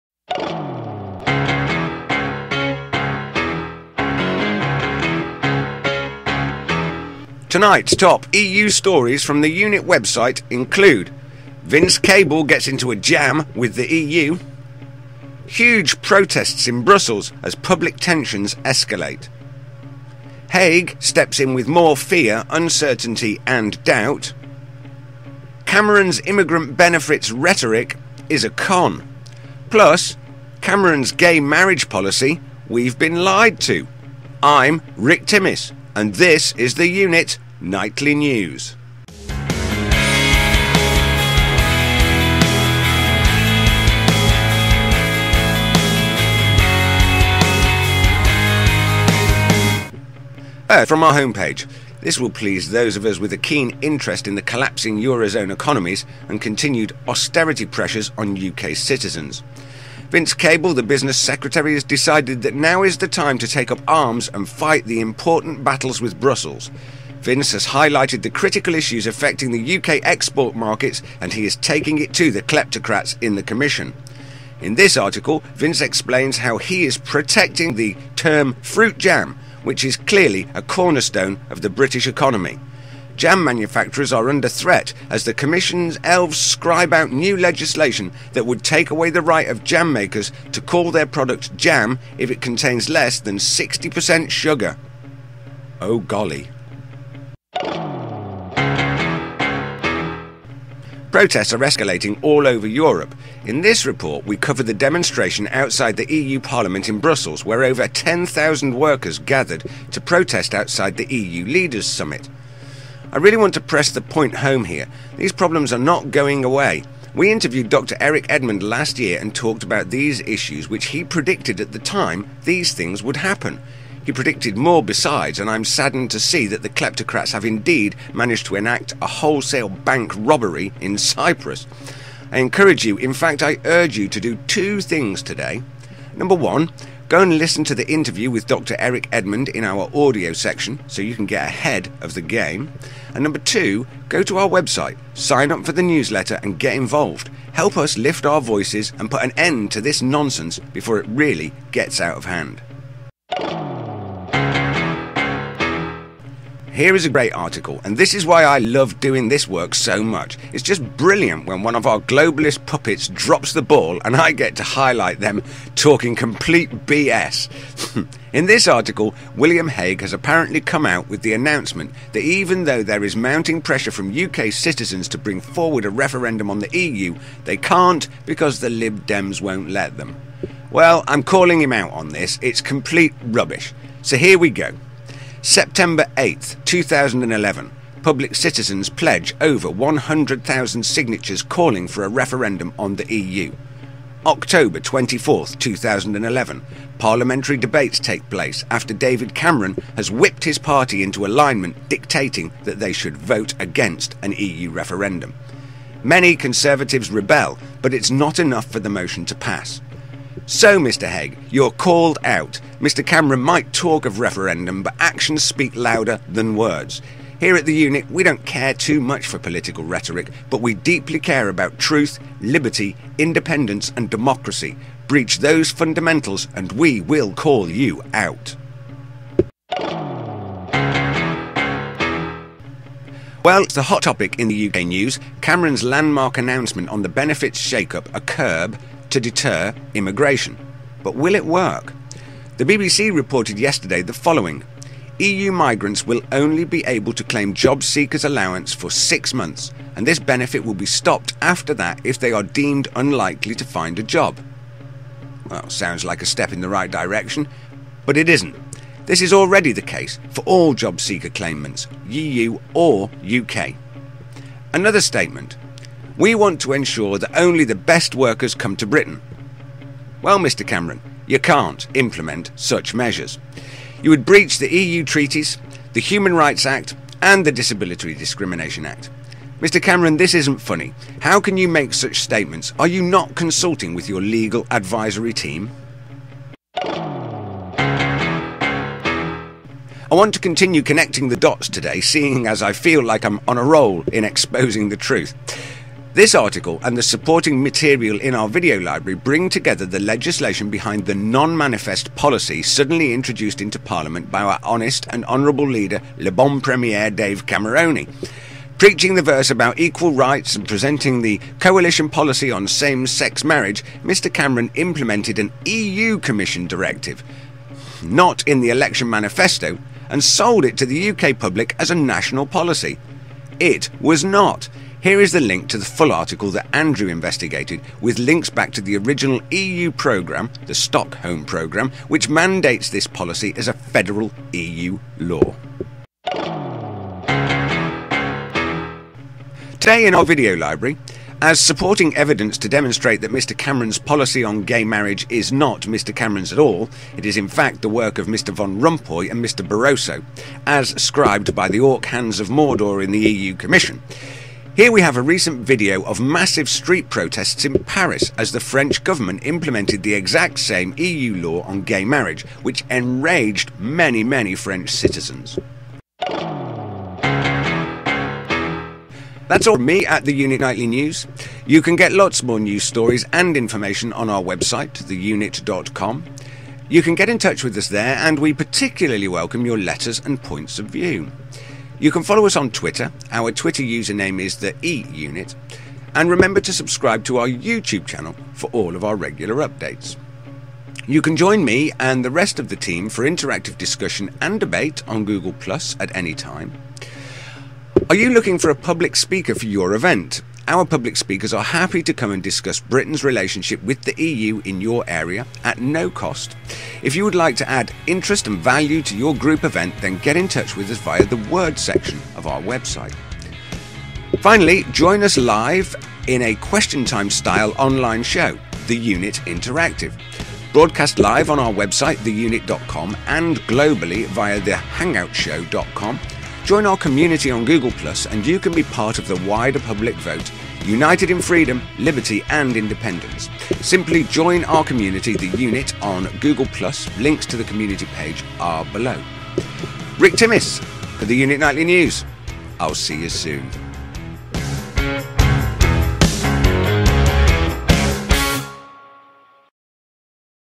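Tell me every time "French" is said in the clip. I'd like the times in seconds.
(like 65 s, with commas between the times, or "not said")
358 s, 364 s.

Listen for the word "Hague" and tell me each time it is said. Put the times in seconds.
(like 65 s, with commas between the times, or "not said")
20 s, 169 s, 211 s.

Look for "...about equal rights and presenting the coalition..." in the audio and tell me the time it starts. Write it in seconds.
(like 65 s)
309 s.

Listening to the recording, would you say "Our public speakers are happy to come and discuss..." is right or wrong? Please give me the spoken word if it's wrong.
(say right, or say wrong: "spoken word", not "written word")
right.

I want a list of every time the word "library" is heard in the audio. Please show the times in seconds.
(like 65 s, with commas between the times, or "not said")
298 s, 340 s.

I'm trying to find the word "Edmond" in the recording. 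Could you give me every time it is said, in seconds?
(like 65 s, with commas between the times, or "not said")
118 s, 139 s.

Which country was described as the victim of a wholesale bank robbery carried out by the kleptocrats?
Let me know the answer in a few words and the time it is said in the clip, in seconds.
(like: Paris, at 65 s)
Cyprus, at 130 s.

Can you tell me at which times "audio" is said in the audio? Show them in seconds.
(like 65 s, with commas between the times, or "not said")
139 s.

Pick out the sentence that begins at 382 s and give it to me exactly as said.
You can follow us on Twitter.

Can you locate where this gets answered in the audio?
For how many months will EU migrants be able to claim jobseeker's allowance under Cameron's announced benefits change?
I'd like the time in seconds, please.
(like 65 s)
248 s.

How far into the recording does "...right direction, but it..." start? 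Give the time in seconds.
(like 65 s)
256 s.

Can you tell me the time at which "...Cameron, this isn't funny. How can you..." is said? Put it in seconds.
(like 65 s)
279 s.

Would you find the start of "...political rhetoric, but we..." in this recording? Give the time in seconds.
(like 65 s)
219 s.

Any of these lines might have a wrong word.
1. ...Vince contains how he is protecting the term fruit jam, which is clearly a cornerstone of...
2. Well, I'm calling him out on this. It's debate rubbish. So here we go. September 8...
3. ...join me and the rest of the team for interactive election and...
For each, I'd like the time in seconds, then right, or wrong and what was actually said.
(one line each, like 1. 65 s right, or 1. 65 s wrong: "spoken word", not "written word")
1. 75 s wrong: "explains", not "contains"
2. 180 s wrong: "complete", not "debate"
3. 391 s wrong: "discussion", not "election".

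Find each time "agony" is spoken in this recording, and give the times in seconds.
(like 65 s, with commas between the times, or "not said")
not said.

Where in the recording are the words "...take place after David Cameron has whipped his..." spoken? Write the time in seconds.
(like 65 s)
197 s.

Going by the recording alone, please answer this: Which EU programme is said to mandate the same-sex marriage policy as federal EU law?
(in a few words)
Stockholm Programme.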